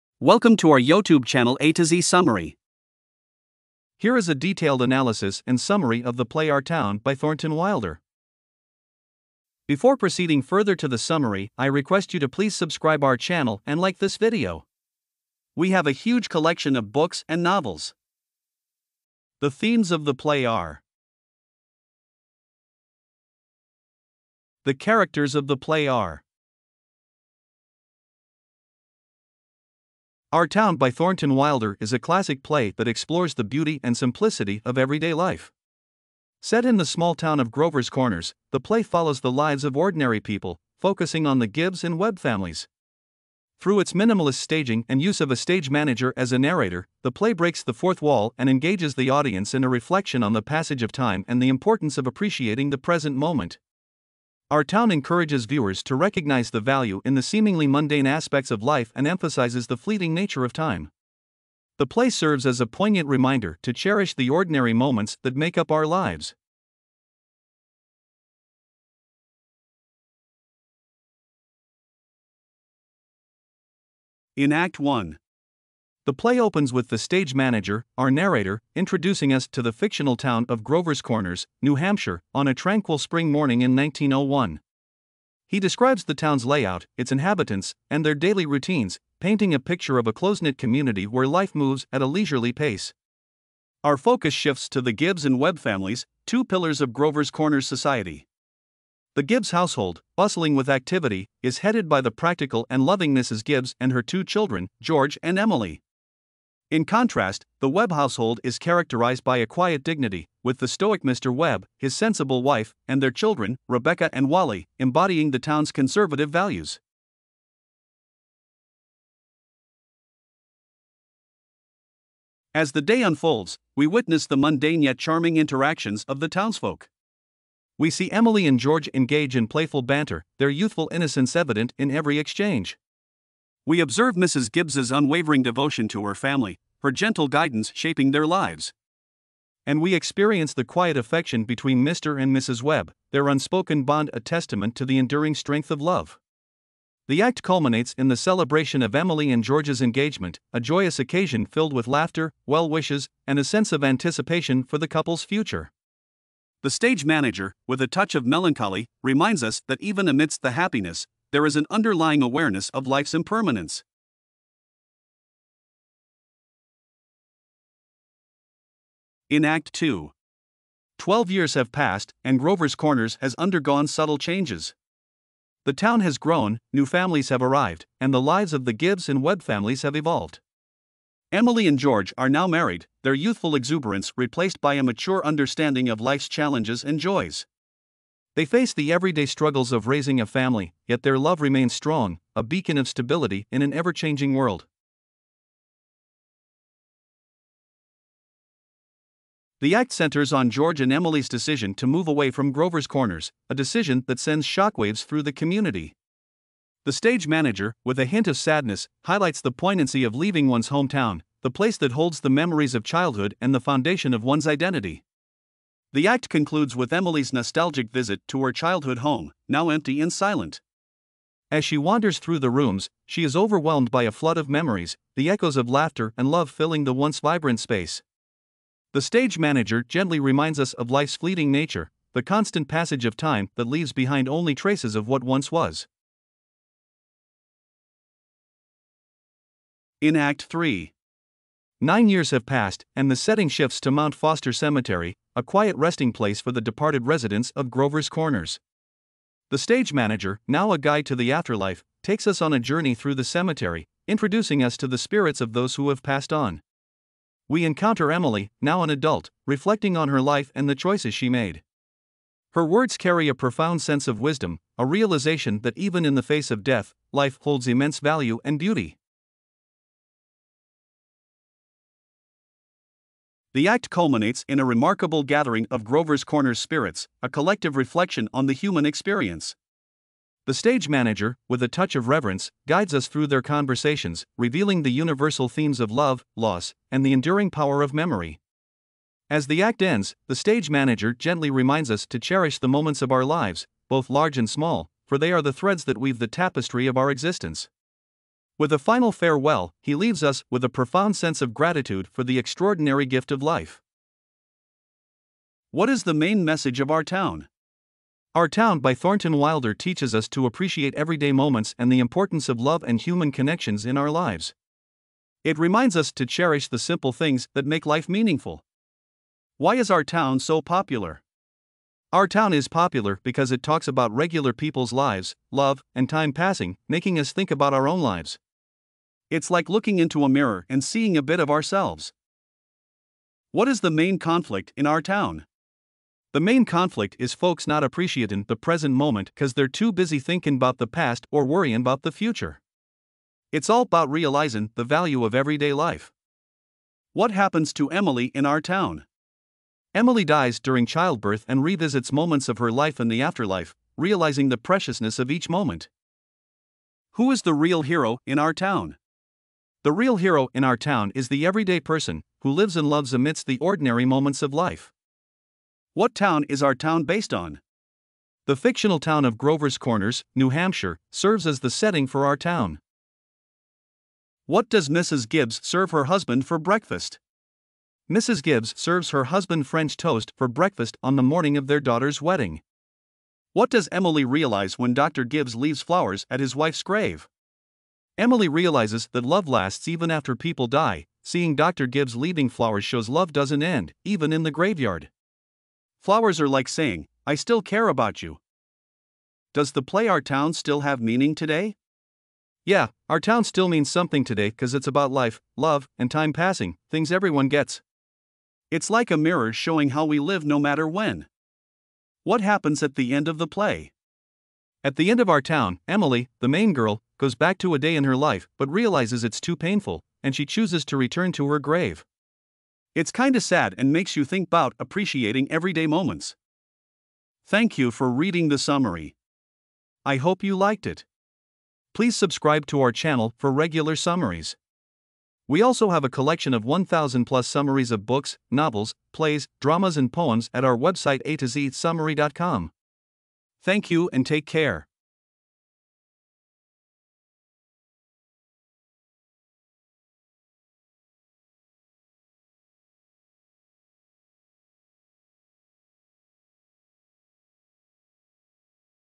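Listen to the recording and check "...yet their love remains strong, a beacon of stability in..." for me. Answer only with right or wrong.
right.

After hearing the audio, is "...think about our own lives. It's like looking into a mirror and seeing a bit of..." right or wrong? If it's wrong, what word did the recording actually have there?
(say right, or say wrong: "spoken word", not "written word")
right.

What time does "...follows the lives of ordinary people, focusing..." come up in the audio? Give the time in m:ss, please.
0:38.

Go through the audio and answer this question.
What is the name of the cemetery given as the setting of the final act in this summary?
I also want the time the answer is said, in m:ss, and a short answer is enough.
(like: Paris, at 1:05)
Mount Foster Cemetery, at 4:03.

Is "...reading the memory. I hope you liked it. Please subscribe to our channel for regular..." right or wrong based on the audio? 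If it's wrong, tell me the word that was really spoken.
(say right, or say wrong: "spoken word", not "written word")
wrong: "summary", not "memory".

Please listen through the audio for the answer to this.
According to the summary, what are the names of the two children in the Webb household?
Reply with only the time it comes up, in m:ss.
1:53.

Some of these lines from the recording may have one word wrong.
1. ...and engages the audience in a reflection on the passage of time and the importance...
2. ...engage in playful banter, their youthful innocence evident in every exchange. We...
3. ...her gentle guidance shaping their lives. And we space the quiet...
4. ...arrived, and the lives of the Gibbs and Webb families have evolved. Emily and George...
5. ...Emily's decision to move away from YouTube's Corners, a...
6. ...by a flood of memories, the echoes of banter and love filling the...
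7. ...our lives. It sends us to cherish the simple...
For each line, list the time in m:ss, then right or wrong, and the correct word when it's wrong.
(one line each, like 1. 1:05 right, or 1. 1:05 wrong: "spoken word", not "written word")
1. 0:48 right
2. 2:08 right
3. 2:16 wrong: "experience", not "space"
4. 2:57 right
5. 3:20 wrong: "Grover", not "YouTube"
6. 3:43 wrong: "laughter", not "banter"
7. 5:13 wrong: "reminds", not "sends".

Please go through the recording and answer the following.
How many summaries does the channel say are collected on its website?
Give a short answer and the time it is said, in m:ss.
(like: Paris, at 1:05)
1,000 plus, at 7:16.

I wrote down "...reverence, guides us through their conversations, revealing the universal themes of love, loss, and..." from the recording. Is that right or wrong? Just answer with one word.
right.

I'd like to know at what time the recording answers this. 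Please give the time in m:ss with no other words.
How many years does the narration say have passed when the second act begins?
2:50.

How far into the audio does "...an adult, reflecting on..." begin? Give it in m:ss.
4:18.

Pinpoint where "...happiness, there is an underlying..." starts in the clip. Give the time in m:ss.
2:40.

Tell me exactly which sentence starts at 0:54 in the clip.
Our town encourages viewers to recognize the value in the seemingly mundane aspects of life and emphasizes the fleeting nature of time.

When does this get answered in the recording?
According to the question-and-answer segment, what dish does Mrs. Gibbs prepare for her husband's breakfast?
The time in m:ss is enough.
6:19.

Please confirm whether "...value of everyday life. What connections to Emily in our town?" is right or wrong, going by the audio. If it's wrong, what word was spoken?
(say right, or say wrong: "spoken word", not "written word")
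wrong: "happens", not "connections".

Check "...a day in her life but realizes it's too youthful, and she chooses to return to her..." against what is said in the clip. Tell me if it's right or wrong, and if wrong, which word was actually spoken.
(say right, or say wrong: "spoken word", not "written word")
wrong: "painful", not "youthful".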